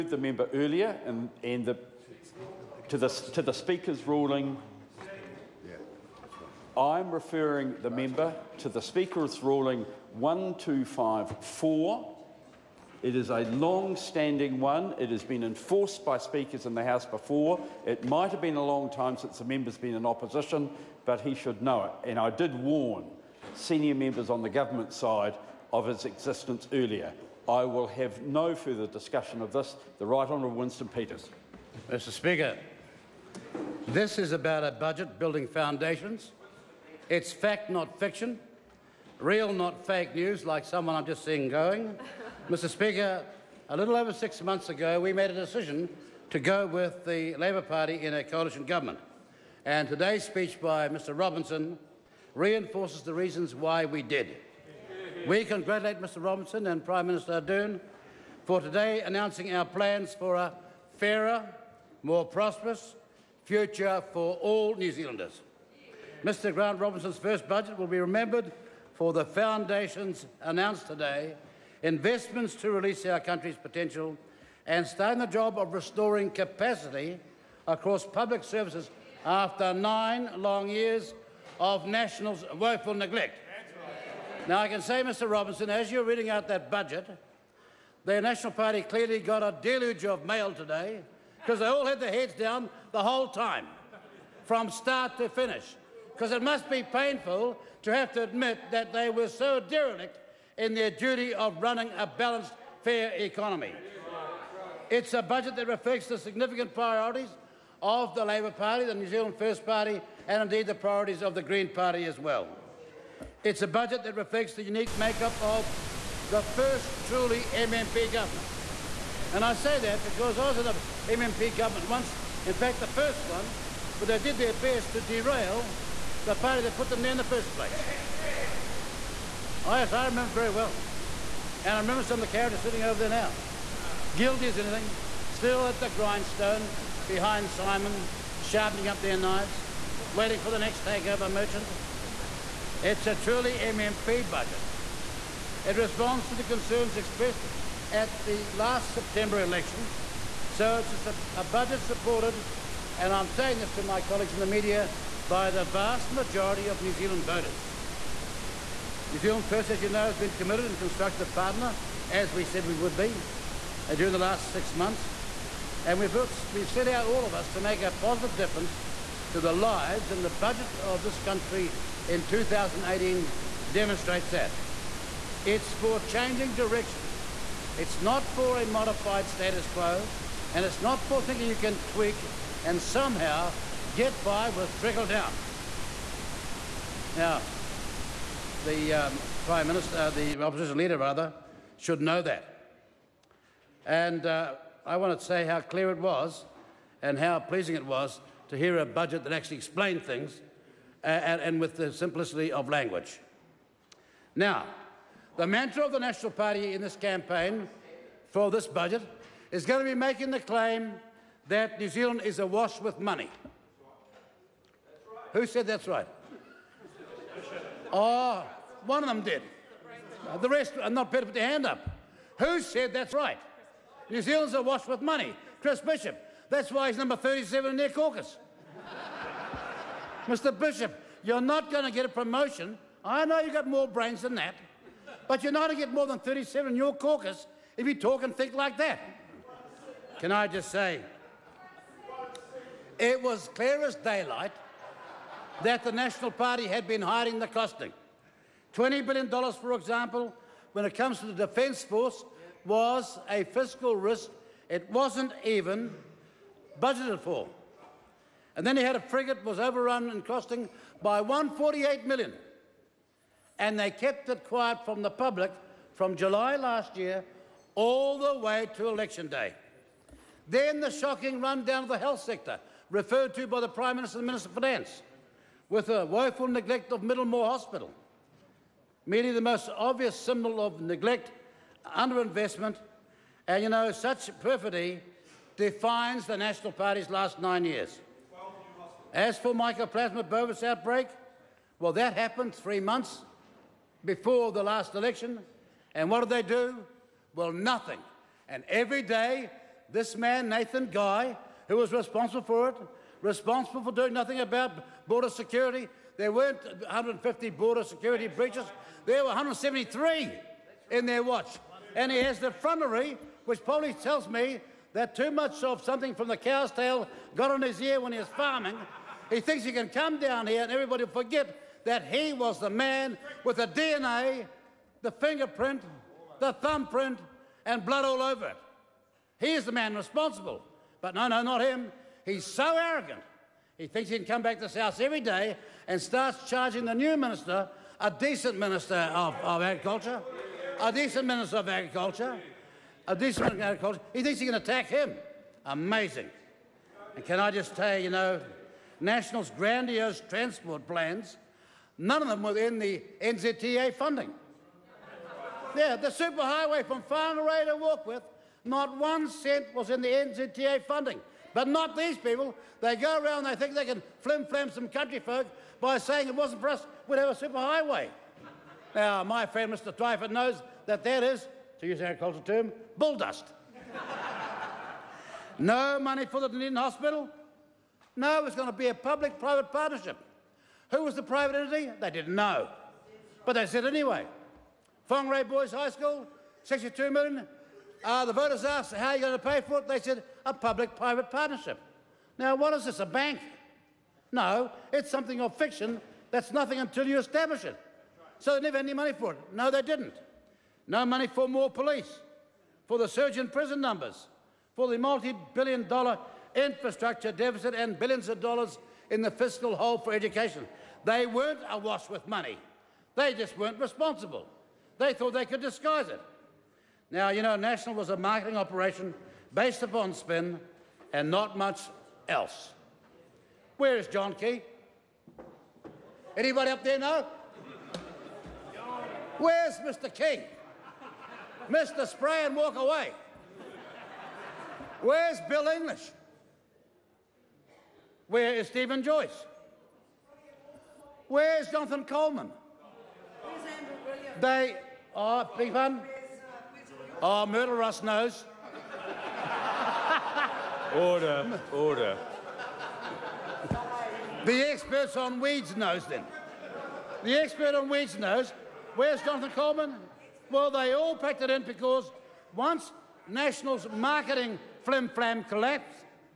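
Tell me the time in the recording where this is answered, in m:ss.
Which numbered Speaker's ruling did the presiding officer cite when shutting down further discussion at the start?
0:10.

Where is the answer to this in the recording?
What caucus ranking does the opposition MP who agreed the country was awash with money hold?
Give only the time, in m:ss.
3:46.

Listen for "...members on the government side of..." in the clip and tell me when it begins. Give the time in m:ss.
0:23.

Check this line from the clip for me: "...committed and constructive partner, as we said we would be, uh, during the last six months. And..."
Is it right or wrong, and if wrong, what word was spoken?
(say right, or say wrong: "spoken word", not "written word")
right.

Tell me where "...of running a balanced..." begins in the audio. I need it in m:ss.
1:41.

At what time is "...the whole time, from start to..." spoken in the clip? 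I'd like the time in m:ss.
1:32.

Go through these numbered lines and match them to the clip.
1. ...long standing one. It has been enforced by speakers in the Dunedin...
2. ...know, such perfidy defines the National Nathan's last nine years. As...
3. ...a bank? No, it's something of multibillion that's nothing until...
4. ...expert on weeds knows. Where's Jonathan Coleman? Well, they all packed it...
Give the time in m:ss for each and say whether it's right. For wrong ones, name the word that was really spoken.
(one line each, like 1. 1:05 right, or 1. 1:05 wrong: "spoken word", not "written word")
1. 0:13 wrong: "House", not "Dunedin"
2. 4:43 wrong: "Party", not "Nathan"
3. 6:32 wrong: "fiction", not "multibillion"
4. 7:37 right.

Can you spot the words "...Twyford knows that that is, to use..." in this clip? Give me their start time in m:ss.
6:09.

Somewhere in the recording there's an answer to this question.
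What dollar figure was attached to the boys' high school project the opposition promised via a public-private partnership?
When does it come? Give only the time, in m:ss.
6:26.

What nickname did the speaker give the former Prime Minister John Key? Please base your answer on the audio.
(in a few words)
Mr. Spray and Walk Away.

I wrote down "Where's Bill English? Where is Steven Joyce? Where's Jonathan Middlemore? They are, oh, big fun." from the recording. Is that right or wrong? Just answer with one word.
wrong.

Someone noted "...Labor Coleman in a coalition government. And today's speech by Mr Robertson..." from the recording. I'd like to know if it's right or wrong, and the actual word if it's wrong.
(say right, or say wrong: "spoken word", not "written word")
wrong: "Party", not "Coleman".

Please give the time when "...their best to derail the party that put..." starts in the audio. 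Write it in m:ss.
2:04.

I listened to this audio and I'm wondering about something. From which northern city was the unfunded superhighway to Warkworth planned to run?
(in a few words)
Whangarei.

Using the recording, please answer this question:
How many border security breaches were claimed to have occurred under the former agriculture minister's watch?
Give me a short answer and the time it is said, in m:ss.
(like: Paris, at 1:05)
173, at 5:09.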